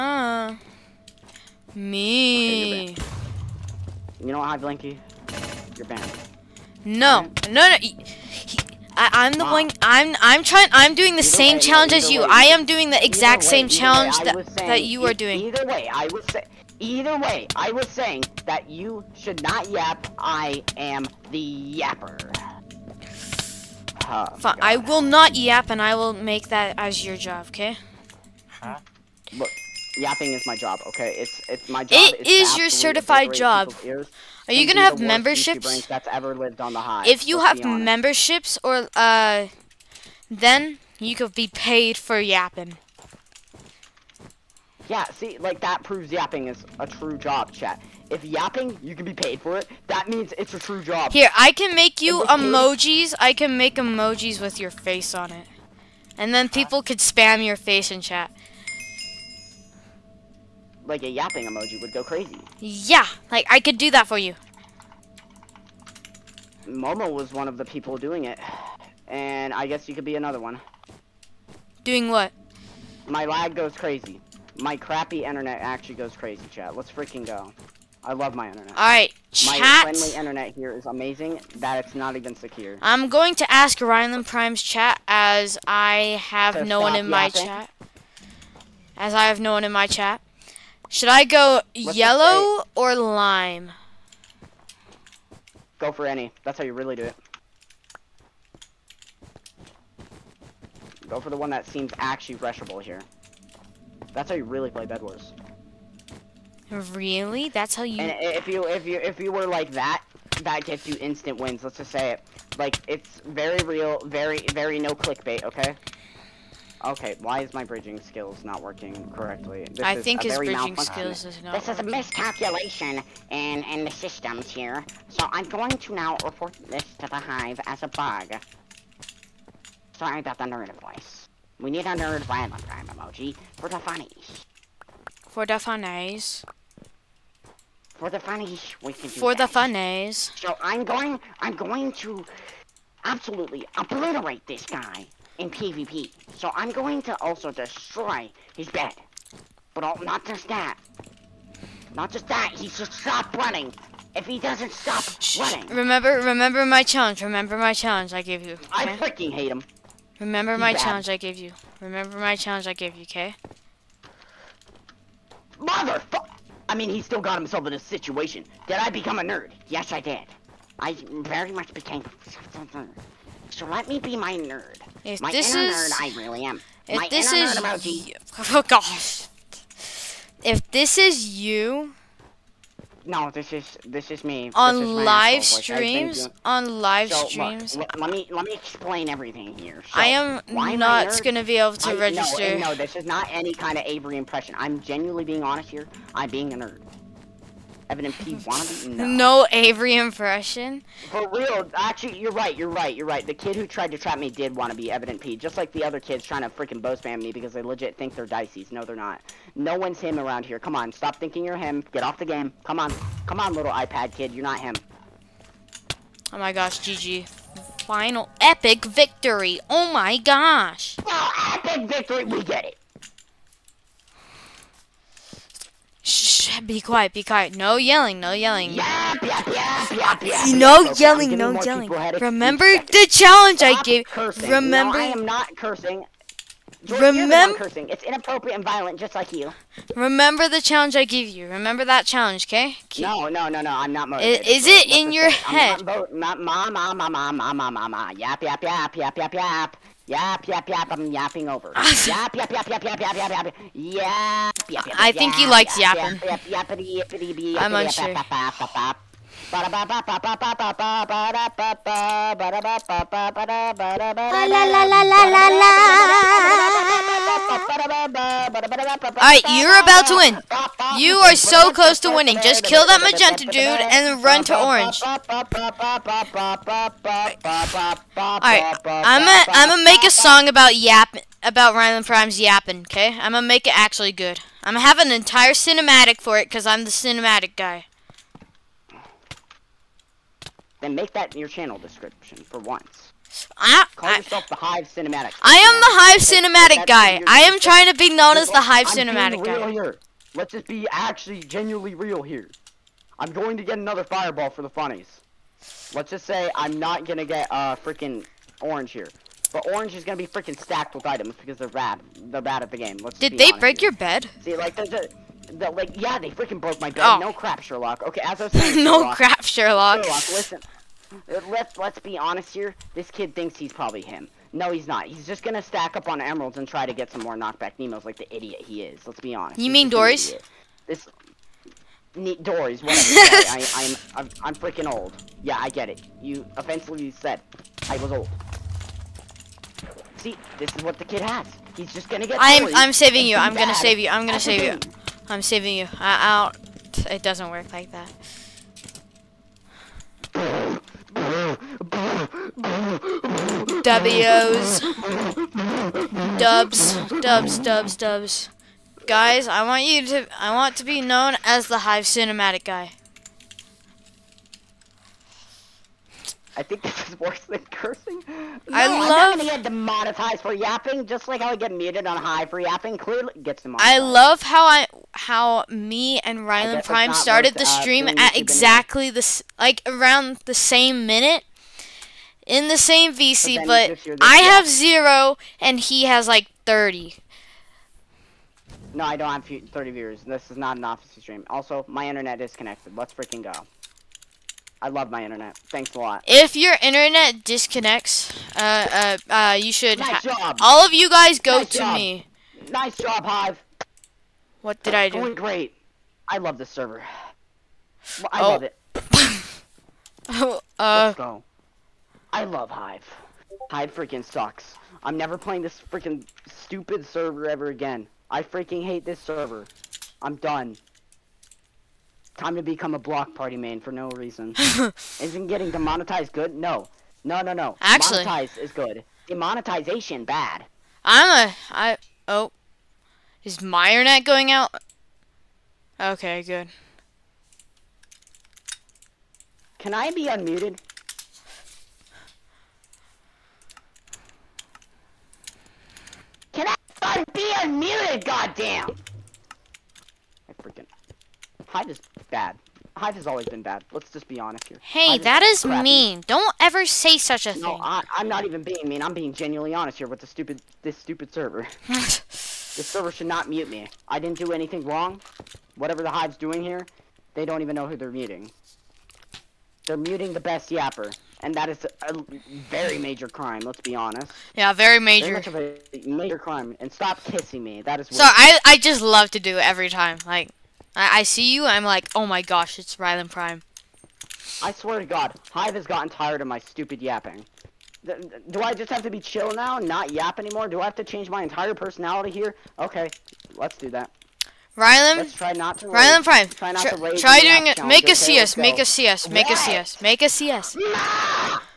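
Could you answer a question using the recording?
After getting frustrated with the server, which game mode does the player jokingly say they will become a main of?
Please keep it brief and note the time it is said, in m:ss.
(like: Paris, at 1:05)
Block Party, at 7:02.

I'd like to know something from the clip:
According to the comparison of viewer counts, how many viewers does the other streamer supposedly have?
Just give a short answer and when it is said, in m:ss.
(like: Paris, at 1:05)
30, at 6:26.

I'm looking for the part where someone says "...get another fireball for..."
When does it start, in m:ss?
5:03.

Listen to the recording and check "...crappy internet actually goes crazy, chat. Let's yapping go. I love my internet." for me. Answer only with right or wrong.
wrong.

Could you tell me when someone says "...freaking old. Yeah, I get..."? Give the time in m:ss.
5:34.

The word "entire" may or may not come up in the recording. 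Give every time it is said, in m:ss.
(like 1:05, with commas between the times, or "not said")
4:45, 8:11.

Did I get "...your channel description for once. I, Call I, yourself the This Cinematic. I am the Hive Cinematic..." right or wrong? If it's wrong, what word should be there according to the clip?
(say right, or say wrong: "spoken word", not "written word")
wrong: "Hive", not "This".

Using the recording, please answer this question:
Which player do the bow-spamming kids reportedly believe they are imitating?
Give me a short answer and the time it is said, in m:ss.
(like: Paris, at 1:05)
dicey, at 3:28.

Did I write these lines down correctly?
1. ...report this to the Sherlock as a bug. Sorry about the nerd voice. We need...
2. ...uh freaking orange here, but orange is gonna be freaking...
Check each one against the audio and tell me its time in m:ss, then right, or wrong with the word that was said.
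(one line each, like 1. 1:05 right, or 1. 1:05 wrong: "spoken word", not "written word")
1. 2:06 wrong: "Hive", not "Sherlock"
2. 5:07 right.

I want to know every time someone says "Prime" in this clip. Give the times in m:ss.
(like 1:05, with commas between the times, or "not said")
1:24, 4:42, 6:16, 8:03, 8:16.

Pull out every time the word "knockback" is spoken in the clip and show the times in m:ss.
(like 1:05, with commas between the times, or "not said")
5:27.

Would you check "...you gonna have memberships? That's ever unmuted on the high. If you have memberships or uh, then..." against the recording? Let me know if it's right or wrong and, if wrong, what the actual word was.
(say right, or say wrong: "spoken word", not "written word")
wrong: "lived", not "unmuted".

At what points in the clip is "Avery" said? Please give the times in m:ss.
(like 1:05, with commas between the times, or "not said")
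3:13, 3:19.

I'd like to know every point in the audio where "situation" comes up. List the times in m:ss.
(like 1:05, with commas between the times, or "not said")
2:47.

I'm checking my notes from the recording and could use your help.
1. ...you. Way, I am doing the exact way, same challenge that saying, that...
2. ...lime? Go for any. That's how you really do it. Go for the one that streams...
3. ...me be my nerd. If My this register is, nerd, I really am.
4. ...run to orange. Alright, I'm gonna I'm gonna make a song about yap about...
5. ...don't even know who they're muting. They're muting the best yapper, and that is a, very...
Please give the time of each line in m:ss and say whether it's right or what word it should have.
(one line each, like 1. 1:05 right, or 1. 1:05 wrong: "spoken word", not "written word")
1. 0:12 right
2. 1:32 wrong: "seems", not "streams"
3. 2:53 wrong: "inner", not "register"
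4. 4:34 right
5. 7:47 right.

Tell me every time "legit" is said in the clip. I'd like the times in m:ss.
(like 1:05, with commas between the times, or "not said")
3:27.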